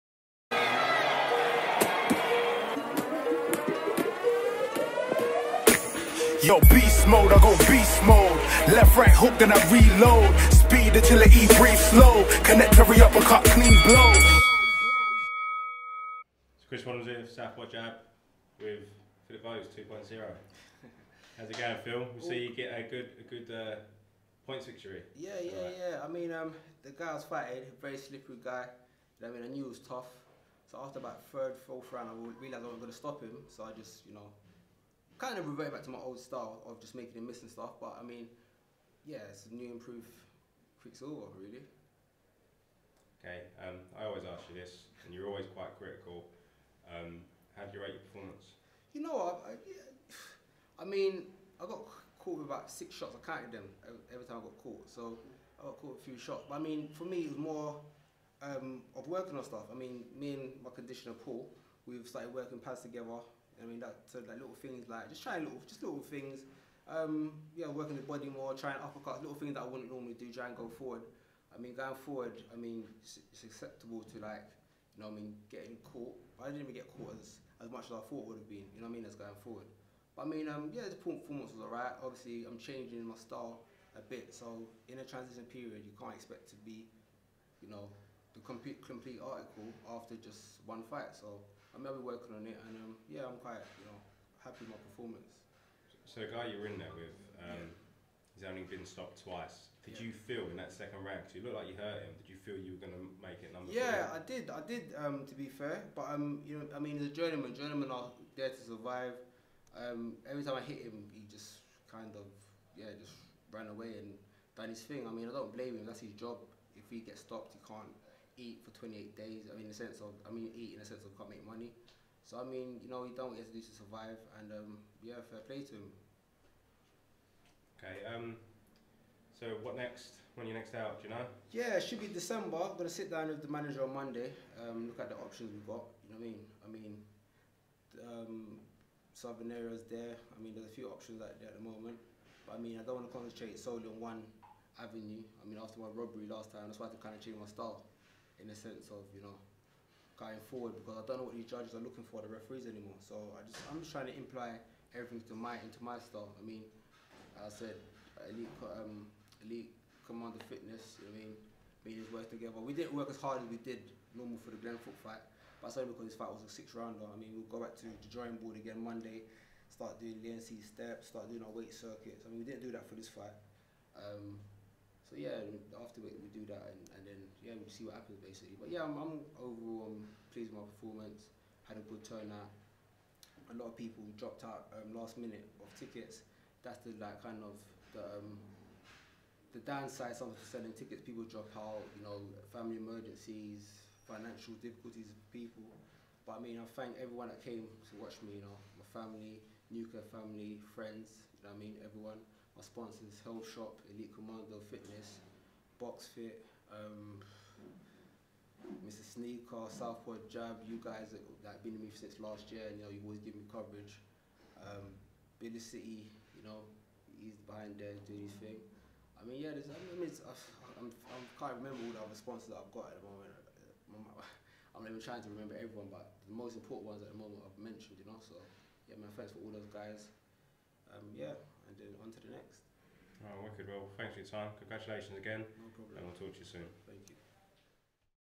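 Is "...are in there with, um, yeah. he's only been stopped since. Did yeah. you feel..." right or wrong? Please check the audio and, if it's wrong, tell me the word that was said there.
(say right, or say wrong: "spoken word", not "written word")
wrong: "twice", not "since".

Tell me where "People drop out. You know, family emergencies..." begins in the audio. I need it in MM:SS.
03:11.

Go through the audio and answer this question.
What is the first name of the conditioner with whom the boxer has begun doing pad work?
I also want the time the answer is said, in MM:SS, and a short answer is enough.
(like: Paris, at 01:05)
Paul, at 01:01.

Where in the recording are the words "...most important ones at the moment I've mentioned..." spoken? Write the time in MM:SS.
03:46.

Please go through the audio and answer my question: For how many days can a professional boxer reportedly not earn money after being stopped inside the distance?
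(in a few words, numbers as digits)
28.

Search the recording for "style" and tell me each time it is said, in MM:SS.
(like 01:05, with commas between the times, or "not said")
00:36, 01:23, 02:27, 02:36.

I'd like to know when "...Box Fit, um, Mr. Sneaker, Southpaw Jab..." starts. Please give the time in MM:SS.
03:25.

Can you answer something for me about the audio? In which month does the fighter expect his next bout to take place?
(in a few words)
December.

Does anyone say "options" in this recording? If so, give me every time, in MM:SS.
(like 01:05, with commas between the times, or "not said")
02:15, 02:20.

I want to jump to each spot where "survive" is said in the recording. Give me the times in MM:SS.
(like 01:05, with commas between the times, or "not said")
01:48, 02:03.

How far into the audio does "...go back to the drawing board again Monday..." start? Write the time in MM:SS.
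02:47.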